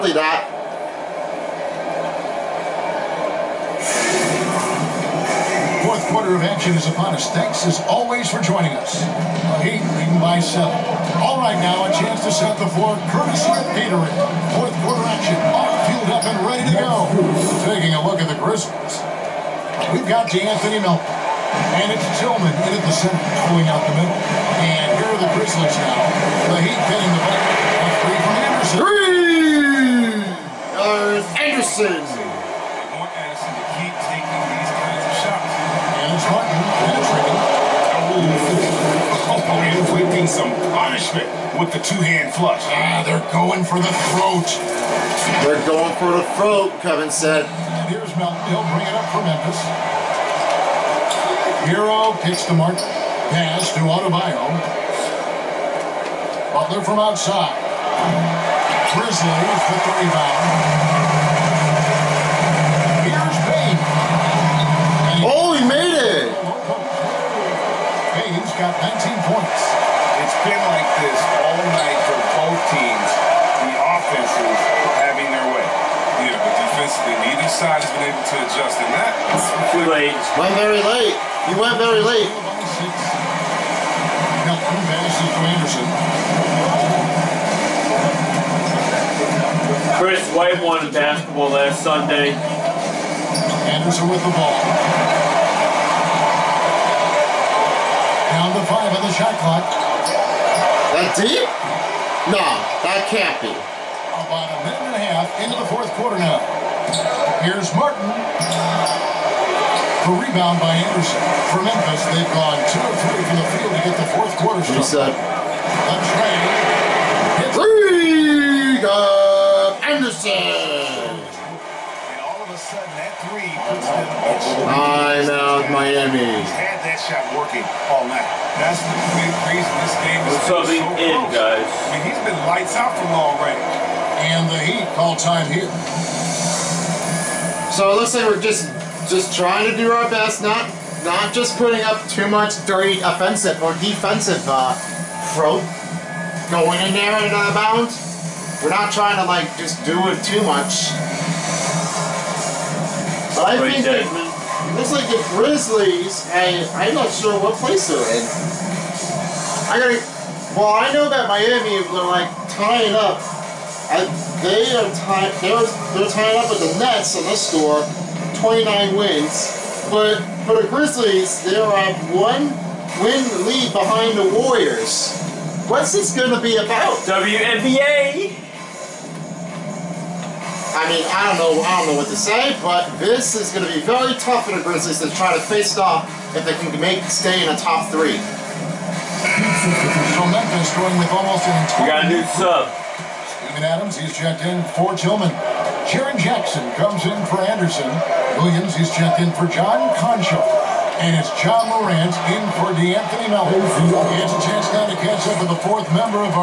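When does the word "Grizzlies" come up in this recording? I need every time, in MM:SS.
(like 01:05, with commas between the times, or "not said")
00:18, 00:25, 00:58, 02:35, 02:50, 03:04.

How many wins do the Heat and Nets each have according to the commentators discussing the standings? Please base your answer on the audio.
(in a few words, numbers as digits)
29.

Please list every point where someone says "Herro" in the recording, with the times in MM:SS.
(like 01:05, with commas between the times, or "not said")
00:51.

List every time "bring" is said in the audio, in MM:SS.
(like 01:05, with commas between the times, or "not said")
00:48.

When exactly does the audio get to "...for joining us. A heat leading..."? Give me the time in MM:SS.
00:08.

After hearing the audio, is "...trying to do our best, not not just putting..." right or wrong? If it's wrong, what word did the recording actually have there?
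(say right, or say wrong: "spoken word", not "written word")
right.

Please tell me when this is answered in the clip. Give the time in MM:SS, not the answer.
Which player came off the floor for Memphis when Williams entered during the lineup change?
03:19.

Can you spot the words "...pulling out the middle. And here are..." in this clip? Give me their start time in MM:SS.
00:23.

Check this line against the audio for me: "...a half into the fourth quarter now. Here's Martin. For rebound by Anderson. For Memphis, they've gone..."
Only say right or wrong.
right.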